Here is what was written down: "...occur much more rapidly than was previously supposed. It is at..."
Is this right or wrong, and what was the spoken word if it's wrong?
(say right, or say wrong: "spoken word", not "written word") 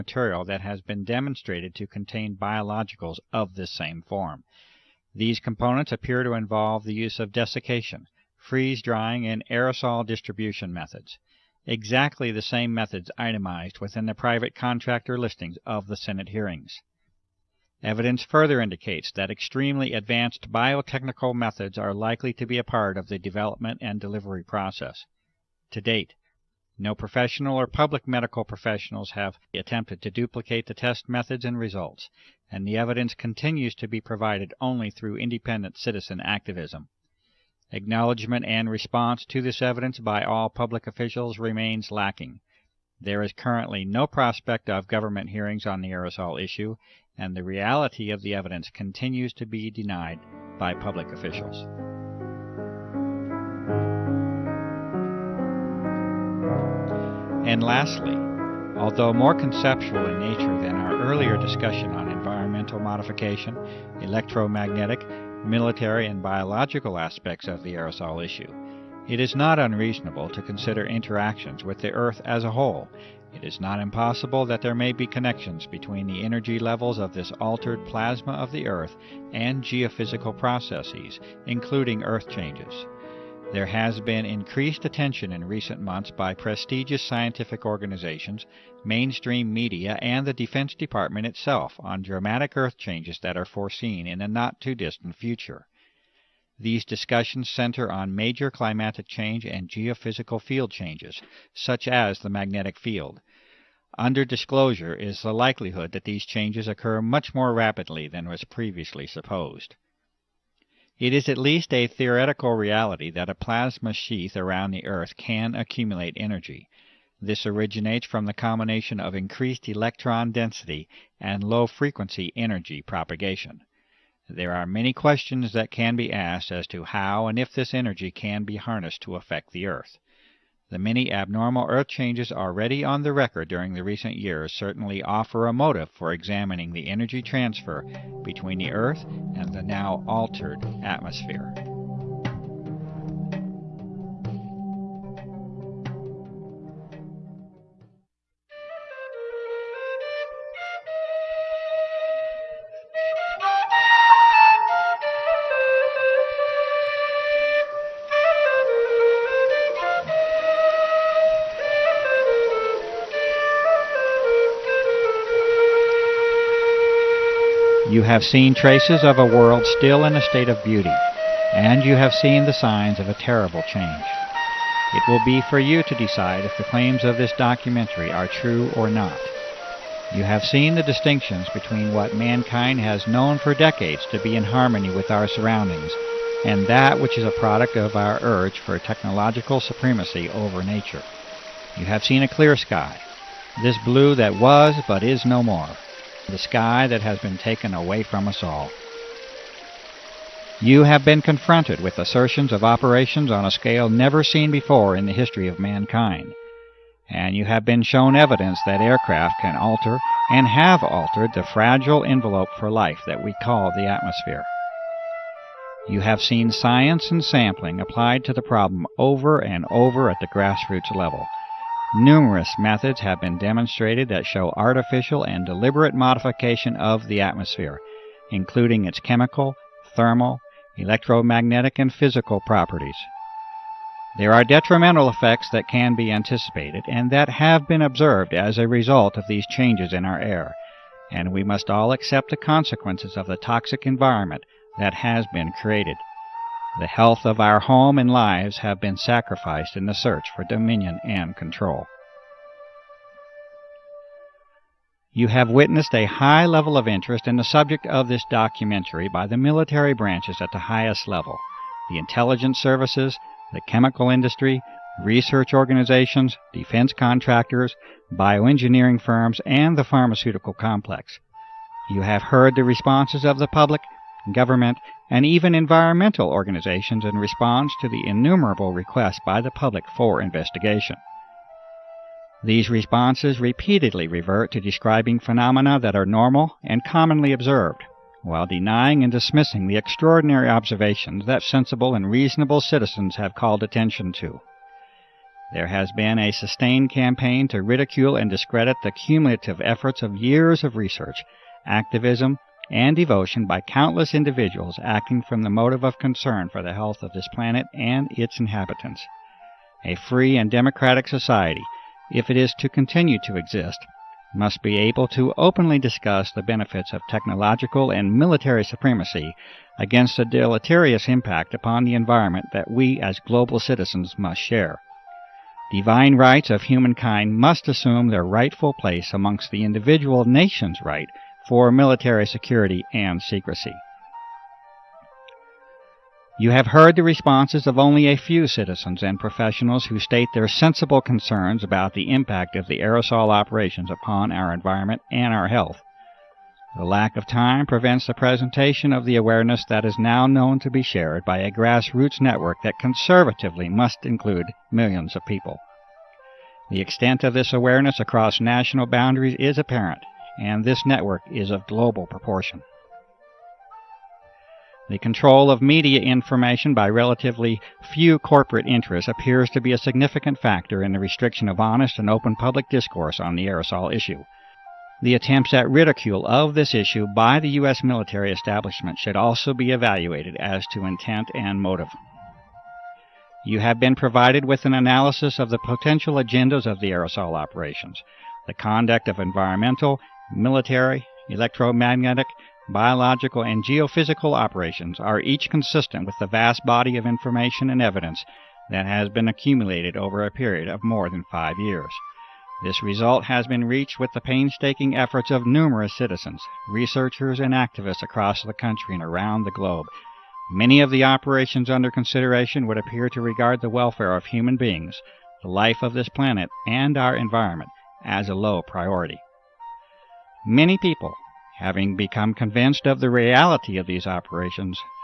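right.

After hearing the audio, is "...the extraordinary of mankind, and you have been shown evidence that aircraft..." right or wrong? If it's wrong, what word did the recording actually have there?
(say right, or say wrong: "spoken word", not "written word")
wrong: "history", not "extraordinary".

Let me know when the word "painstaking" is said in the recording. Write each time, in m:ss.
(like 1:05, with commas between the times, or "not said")
6:44.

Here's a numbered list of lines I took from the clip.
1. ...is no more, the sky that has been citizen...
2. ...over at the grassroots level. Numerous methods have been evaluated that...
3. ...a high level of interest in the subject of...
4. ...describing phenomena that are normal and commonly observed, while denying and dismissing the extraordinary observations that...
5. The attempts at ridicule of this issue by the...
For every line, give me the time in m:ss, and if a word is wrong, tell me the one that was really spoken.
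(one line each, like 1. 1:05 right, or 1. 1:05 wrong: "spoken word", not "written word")
1. 3:15 wrong: "taken", not "citizen"
2. 3:39 wrong: "demonstrated", not "evaluated"
3. 4:15 right
4. 4:44 right
5. 6:15 right.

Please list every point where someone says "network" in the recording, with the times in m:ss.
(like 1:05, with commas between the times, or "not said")
5:52, 6:00.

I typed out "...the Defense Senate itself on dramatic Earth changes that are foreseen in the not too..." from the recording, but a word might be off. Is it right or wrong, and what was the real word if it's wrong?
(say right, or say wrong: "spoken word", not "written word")
wrong: "Department", not "Senate".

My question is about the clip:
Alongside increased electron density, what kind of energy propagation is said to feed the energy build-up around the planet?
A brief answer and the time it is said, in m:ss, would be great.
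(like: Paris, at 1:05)
Low frequency, at 2:01.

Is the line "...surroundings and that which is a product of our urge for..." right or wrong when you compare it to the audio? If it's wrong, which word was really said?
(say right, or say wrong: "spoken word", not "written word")
right.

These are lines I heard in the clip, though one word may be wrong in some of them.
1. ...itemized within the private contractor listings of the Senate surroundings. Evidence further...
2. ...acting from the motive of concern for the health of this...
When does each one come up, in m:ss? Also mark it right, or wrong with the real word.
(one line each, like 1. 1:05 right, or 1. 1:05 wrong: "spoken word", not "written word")
1. 0:13 wrong: "hearings", not "surroundings"
2. 5:04 right.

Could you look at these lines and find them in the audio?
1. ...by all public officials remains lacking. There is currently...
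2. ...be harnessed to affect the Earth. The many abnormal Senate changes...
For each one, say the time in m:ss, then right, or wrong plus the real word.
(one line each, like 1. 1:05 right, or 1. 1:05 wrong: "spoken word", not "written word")
1. 0:39 right
2. 2:08 wrong: "Earth", not "Senate".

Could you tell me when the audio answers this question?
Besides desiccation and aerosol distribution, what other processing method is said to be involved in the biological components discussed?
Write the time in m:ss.
0:08.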